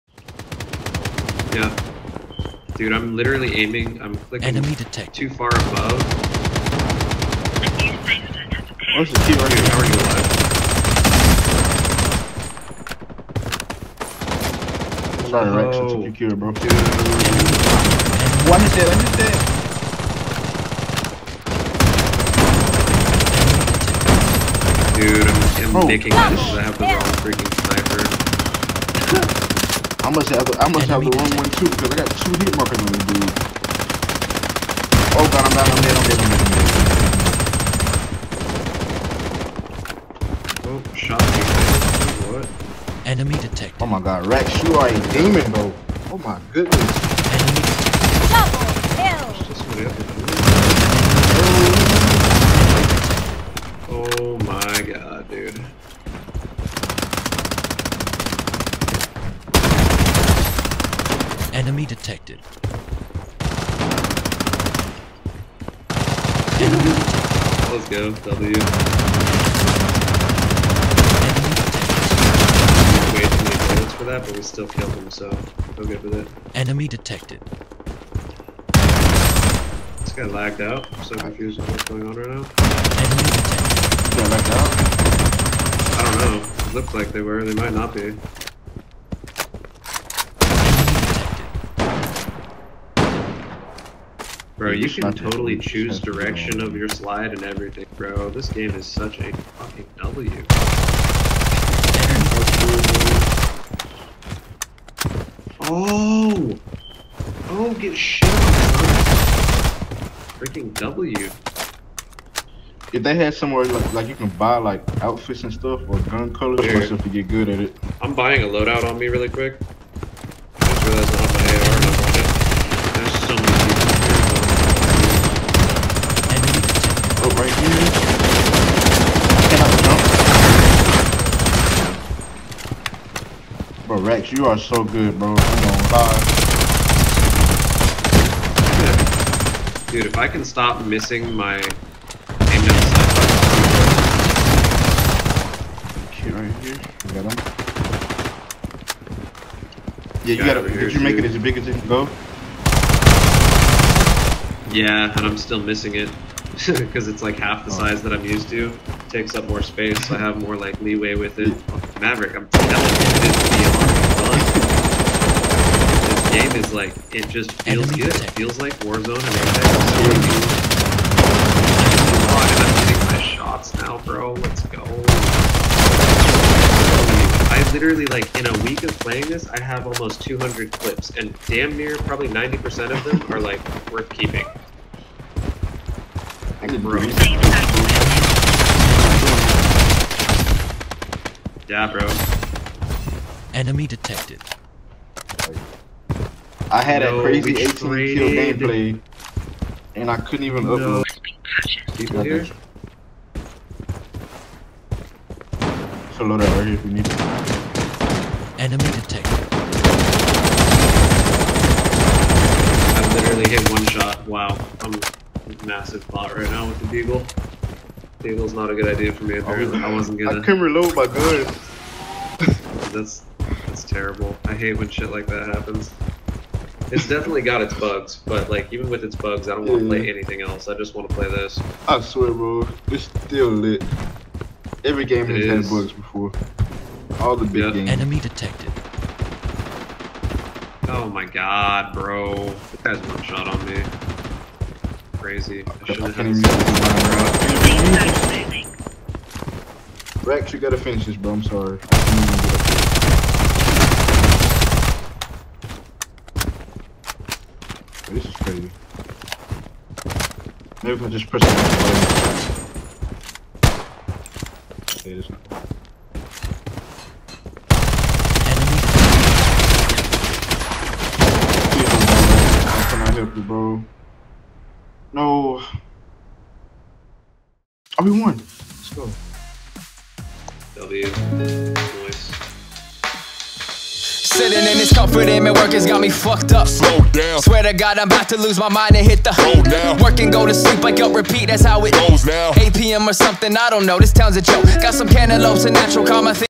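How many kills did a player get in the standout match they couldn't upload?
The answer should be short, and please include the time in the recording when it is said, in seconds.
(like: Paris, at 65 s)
18, at 197 s.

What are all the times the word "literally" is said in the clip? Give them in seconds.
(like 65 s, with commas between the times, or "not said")
3 s, 177 s, 213 s.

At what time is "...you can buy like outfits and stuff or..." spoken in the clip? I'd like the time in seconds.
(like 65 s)
114 s.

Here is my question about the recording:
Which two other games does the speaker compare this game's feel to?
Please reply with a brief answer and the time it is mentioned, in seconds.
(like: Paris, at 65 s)
Warzone and Apex, at 168 s.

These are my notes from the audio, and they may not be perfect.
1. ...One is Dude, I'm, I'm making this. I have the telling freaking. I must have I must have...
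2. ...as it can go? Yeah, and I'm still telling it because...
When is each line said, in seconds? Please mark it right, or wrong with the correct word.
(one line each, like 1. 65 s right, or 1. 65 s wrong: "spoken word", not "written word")
1. 18 s wrong: "wrong", not "telling"
2. 151 s wrong: "missing", not "telling".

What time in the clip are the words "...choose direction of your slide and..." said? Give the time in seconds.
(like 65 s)
95 s.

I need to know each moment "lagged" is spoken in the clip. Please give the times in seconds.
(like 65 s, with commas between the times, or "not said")
80 s, 84 s.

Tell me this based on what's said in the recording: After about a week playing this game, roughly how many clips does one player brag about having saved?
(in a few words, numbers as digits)
200.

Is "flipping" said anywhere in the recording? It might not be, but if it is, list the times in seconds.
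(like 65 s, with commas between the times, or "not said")
not said.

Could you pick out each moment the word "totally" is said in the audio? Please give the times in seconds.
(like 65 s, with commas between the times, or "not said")
95 s.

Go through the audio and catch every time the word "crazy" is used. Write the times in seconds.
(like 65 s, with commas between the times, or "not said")
197 s, 245 s.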